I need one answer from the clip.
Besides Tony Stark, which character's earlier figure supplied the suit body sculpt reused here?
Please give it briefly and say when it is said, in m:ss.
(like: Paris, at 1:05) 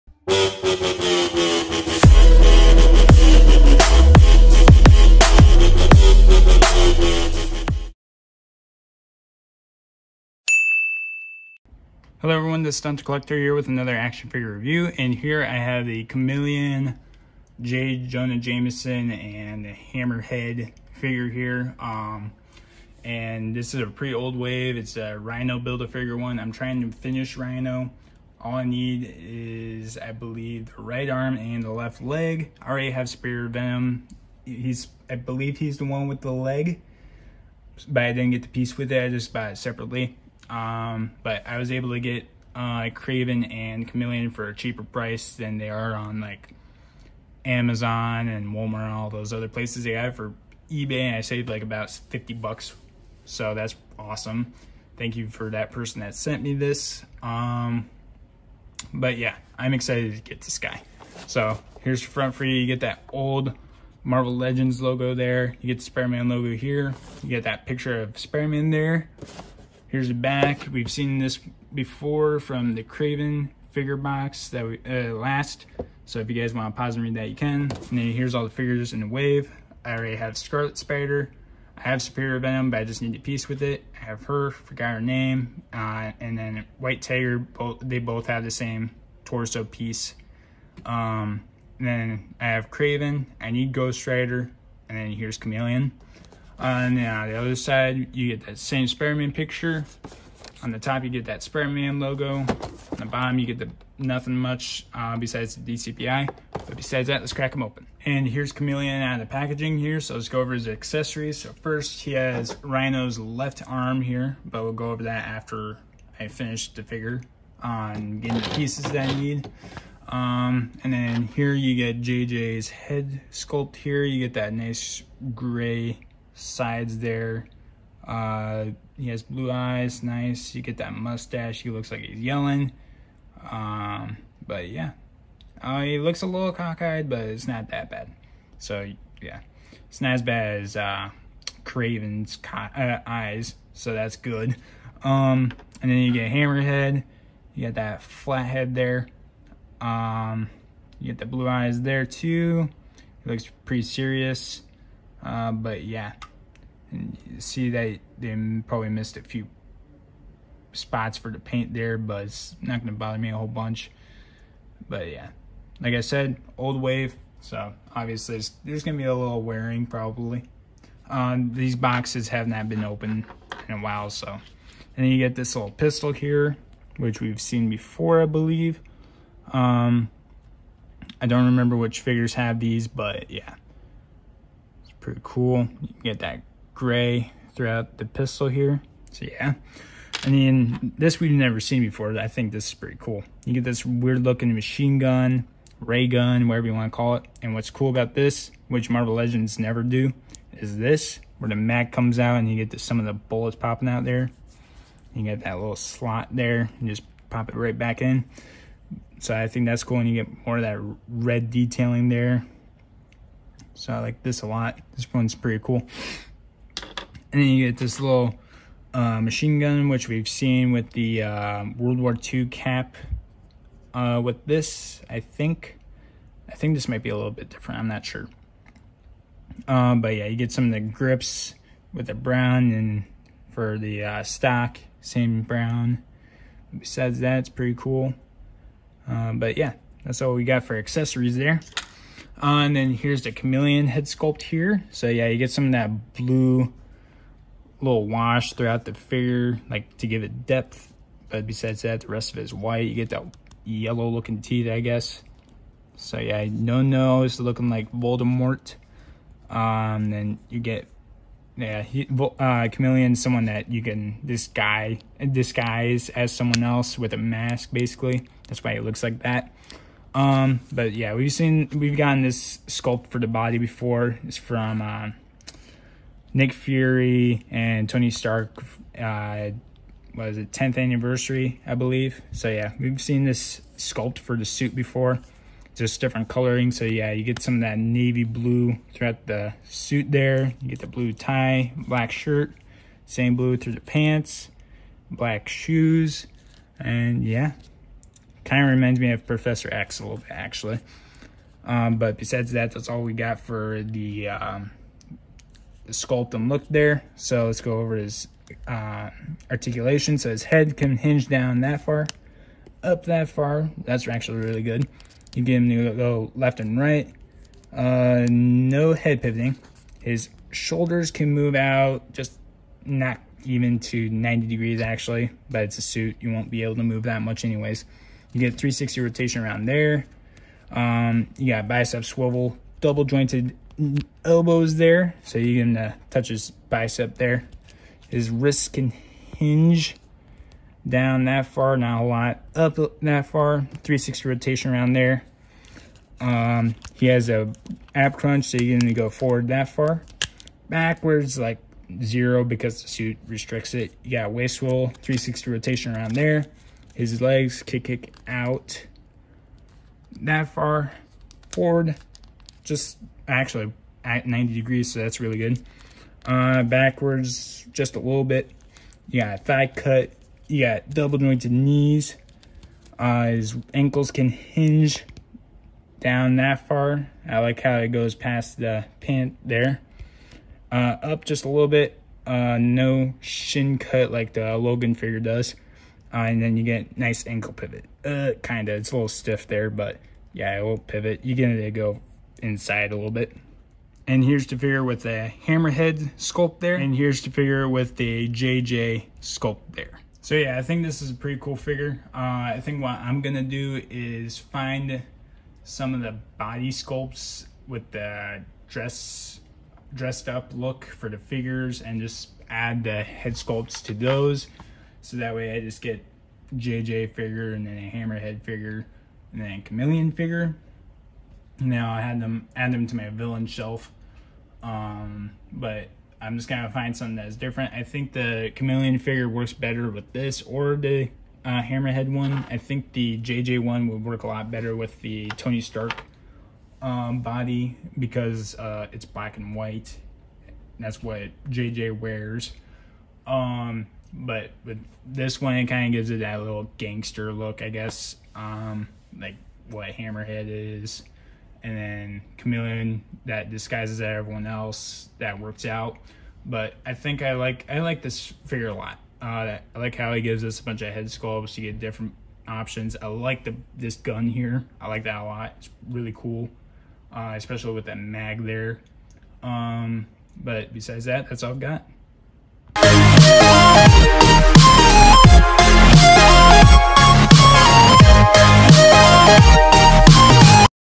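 Nick Fury, at 4:36.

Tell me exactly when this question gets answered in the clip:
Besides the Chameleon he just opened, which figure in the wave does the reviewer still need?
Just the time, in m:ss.
1:33.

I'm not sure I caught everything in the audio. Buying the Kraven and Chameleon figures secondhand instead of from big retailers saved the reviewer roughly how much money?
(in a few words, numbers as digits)
50 bucks.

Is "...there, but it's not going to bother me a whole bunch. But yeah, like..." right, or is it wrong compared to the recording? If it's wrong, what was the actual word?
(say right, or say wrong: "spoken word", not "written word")
right.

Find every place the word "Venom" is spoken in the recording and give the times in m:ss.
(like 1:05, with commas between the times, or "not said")
0:33, 1:22.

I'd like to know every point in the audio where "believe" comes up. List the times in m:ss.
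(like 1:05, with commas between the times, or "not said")
0:30, 0:35, 2:58, 4:41.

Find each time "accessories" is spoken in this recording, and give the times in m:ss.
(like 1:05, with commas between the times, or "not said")
1:50, 4:00.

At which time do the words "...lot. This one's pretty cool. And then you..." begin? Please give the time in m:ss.
3:34.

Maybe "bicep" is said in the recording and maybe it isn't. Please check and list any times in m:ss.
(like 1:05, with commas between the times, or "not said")
5:31, 5:36.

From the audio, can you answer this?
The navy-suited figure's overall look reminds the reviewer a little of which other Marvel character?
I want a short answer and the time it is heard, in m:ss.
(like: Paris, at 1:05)
Professor X, at 4:59.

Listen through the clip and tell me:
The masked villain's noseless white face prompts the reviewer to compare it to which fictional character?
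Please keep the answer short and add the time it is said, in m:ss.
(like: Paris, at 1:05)
Voldemort, at 4:17.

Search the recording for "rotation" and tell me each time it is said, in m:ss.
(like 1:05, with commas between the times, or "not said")
5:29, 5:44, 5:55.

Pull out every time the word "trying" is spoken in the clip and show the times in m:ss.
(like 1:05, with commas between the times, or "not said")
0:26.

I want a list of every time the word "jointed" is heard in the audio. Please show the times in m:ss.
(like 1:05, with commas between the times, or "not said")
5:33, 6:11.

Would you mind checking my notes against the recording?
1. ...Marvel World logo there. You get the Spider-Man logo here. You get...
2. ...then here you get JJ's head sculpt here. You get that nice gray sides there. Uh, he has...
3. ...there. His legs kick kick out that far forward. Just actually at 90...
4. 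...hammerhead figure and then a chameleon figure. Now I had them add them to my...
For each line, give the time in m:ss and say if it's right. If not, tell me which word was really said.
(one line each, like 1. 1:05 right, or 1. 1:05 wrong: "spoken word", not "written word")
1. 1:04 wrong: "Legends", not "World"
2. 2:00 right
3. 5:56 right
4. 6:57 right.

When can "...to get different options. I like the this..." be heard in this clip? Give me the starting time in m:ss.
7:41.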